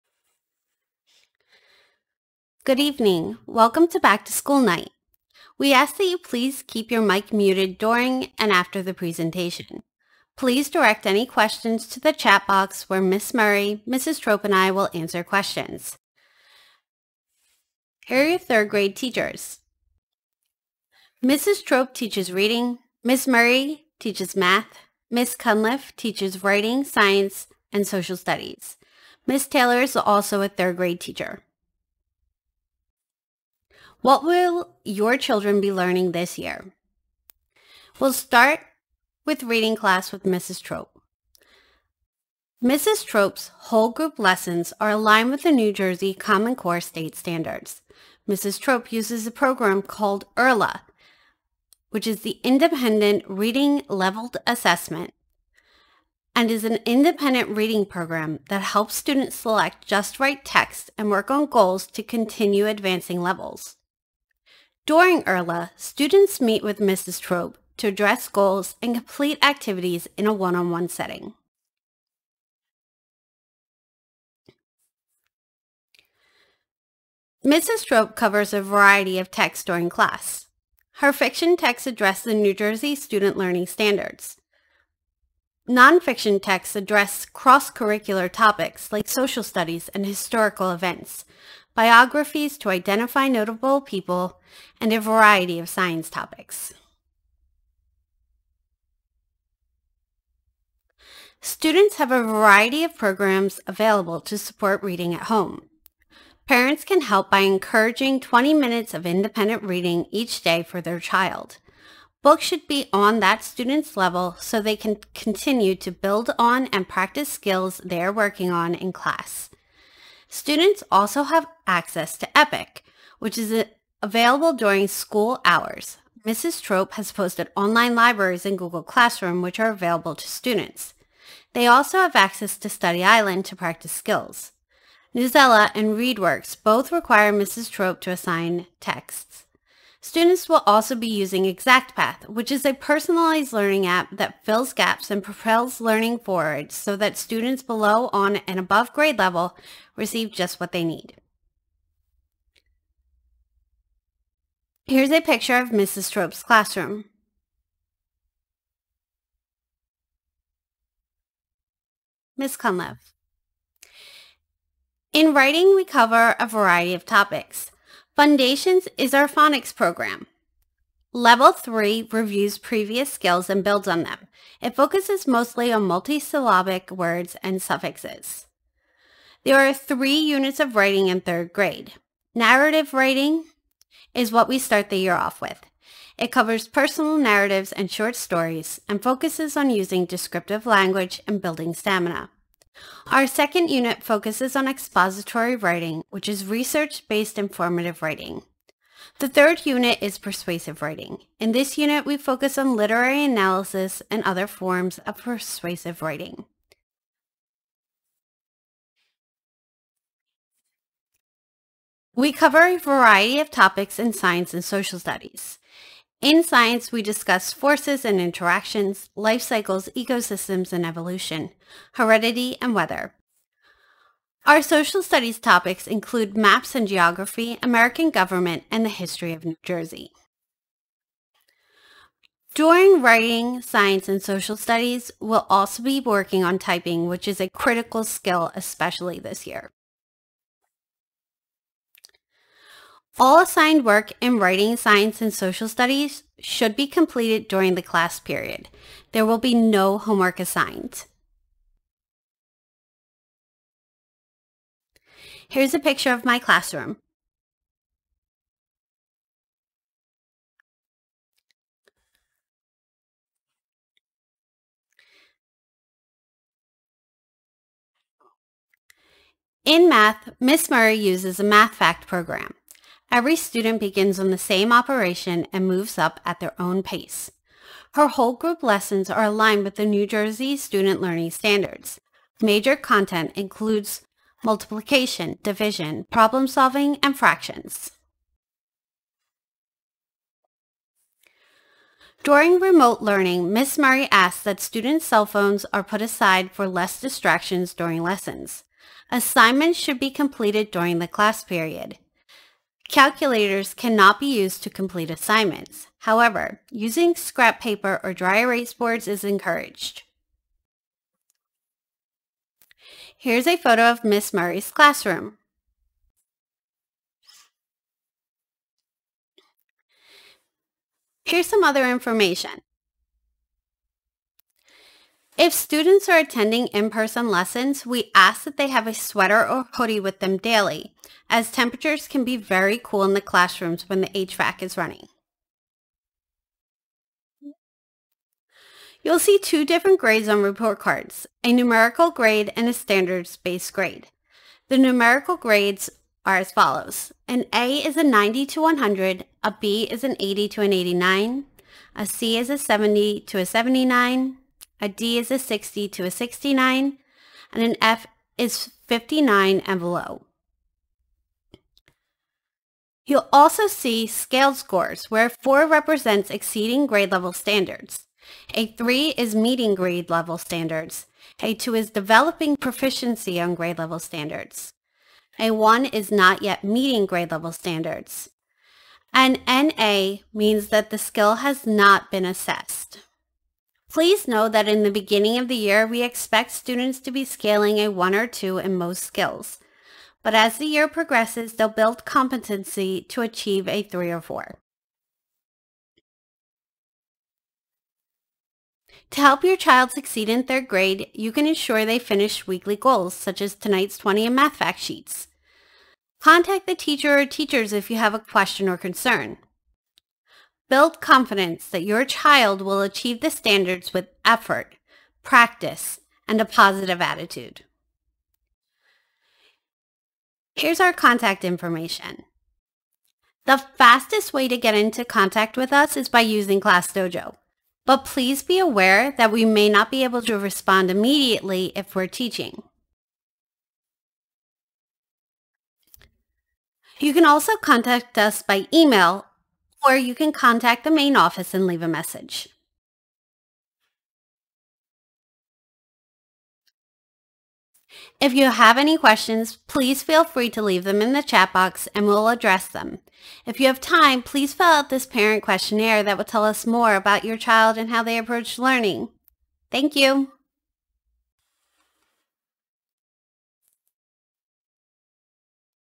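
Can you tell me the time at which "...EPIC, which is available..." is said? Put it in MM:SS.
02:02.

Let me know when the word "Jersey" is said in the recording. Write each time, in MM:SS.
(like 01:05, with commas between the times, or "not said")
00:45, 01:22, 03:49, 04:40.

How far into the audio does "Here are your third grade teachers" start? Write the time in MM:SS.
00:18.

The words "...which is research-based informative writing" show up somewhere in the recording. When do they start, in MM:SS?
03:16.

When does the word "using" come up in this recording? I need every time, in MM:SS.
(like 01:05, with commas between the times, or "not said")
02:21, 03:09, 05:06, 07:06.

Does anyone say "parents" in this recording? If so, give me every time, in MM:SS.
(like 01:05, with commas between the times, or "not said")
01:46, 07:35.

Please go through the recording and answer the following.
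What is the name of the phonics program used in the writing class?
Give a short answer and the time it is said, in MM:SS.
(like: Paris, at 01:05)
Foundations, at 02:48.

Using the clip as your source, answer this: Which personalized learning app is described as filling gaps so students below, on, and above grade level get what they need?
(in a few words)
ExactPath.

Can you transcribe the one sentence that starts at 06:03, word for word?
You'll also see scale scores where 4 represents exceeding grade level standards.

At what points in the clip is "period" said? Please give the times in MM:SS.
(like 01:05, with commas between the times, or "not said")
04:08, 05:01.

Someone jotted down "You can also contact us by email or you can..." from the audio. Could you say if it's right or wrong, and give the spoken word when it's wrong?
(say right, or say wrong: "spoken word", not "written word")
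right.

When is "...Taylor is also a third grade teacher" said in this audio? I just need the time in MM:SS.
00:29.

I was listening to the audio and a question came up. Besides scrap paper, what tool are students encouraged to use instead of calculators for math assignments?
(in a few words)
Dry erase boards.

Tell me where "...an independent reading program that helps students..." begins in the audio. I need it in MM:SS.
00:56.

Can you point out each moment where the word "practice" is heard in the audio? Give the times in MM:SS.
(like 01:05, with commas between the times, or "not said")
01:56, 02:13, 06:55.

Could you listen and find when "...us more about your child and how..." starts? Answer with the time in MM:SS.
07:36.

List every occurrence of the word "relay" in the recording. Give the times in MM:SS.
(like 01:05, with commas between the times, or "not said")
not said.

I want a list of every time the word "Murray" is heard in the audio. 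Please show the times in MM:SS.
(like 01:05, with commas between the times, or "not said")
00:13, 00:23, 04:30, 04:53, 05:14.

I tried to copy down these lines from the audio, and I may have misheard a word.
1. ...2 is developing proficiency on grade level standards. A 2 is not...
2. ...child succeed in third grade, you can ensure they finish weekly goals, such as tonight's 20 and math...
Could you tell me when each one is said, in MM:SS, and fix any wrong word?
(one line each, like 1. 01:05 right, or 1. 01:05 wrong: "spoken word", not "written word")
1. 06:11 wrong: "1", not "2"
2. 06:39 right.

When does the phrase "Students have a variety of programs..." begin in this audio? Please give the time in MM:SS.
01:41.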